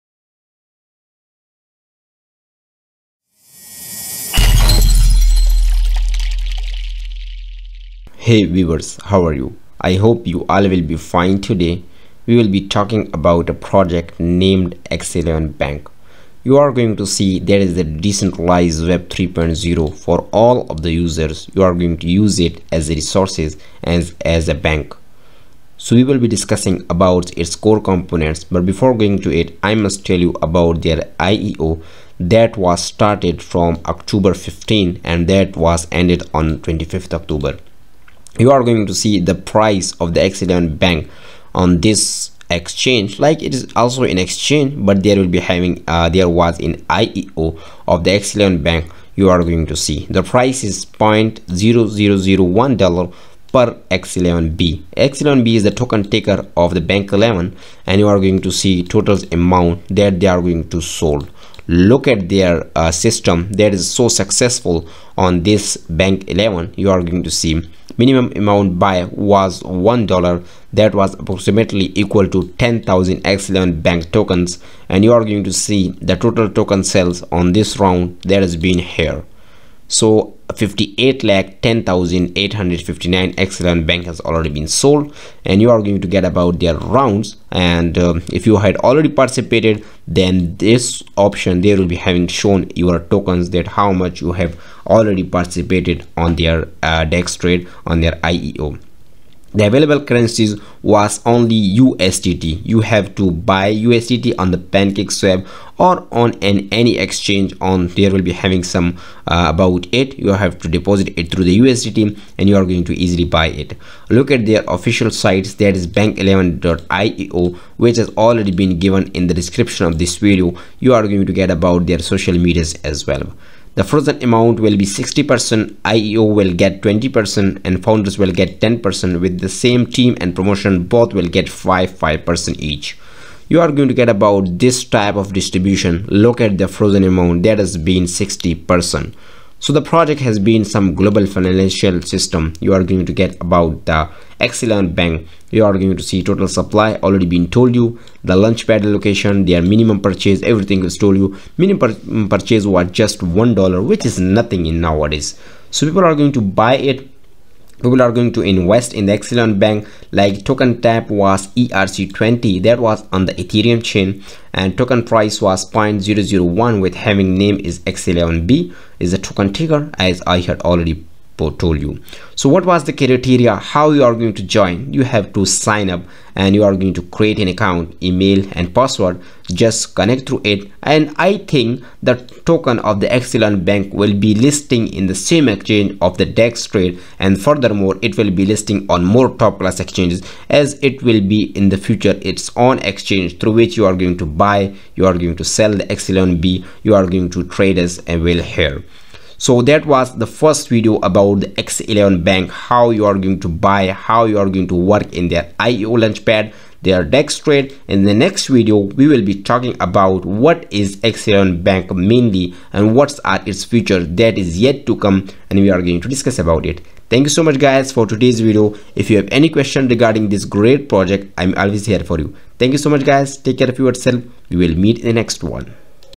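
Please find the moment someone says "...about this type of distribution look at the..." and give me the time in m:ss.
2:14.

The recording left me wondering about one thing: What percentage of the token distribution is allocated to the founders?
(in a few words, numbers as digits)
10%.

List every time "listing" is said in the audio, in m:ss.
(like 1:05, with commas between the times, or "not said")
3:04, 3:08.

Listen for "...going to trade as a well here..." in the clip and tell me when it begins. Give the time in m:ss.
3:17.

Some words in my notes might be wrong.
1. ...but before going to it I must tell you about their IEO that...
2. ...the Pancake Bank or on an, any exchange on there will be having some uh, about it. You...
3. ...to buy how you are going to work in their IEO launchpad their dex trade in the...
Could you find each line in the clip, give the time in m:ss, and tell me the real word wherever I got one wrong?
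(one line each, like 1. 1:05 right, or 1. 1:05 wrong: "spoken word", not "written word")
1. 0:28 right
2. 1:44 wrong: "Swap", not "Bank"
3. 3:23 right.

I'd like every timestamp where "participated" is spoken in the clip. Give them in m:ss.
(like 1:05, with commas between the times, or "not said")
1:29, 1:35.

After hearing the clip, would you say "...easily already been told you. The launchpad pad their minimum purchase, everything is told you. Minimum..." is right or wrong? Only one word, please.
wrong.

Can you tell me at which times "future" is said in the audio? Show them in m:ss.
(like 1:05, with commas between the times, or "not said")
3:11, 3:33.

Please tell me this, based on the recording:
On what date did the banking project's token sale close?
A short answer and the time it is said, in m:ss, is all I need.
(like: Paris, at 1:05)
25th October, at 0:36.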